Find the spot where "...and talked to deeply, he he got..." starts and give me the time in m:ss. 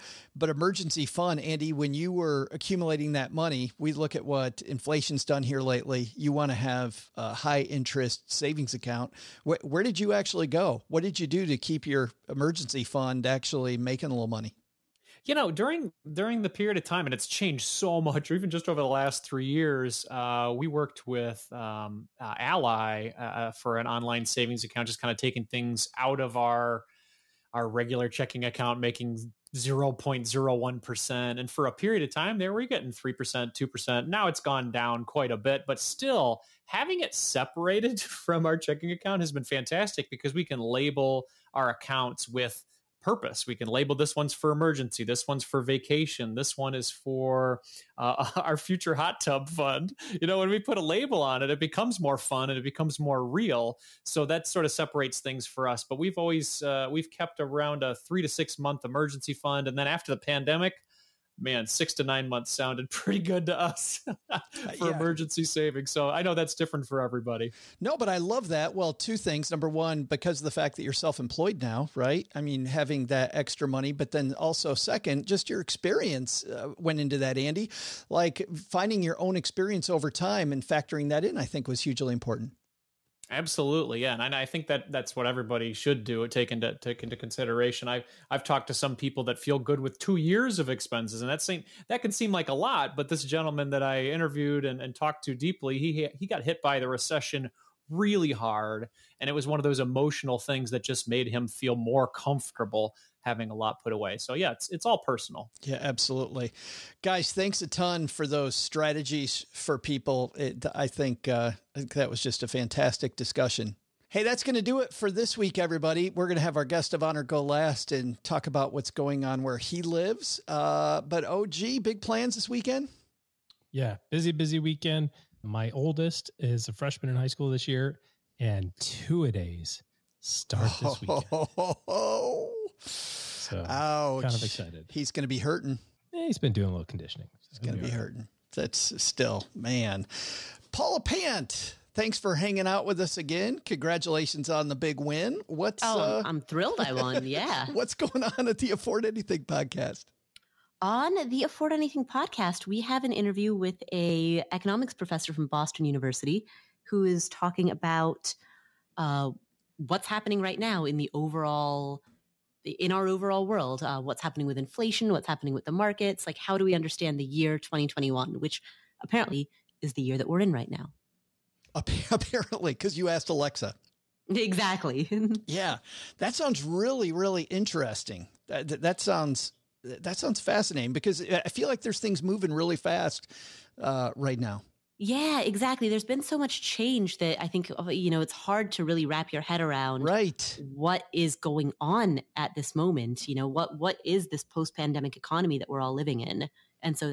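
1:34.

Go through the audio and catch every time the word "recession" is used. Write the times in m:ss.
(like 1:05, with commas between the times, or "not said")
1:36.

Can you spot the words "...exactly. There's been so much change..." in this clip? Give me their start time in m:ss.
3:05.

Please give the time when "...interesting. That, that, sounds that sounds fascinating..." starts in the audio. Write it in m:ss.
2:57.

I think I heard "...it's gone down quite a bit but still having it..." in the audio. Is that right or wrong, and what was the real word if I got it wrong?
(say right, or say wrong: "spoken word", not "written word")
right.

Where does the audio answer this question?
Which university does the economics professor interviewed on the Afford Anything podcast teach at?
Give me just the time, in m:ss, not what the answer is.
2:35.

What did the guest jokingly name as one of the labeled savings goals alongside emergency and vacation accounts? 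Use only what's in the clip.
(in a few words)
hot tub fund.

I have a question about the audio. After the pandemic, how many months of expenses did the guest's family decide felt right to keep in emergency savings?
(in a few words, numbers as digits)
6 to 9 months.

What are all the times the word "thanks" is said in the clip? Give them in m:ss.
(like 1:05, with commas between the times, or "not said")
1:47, 2:21.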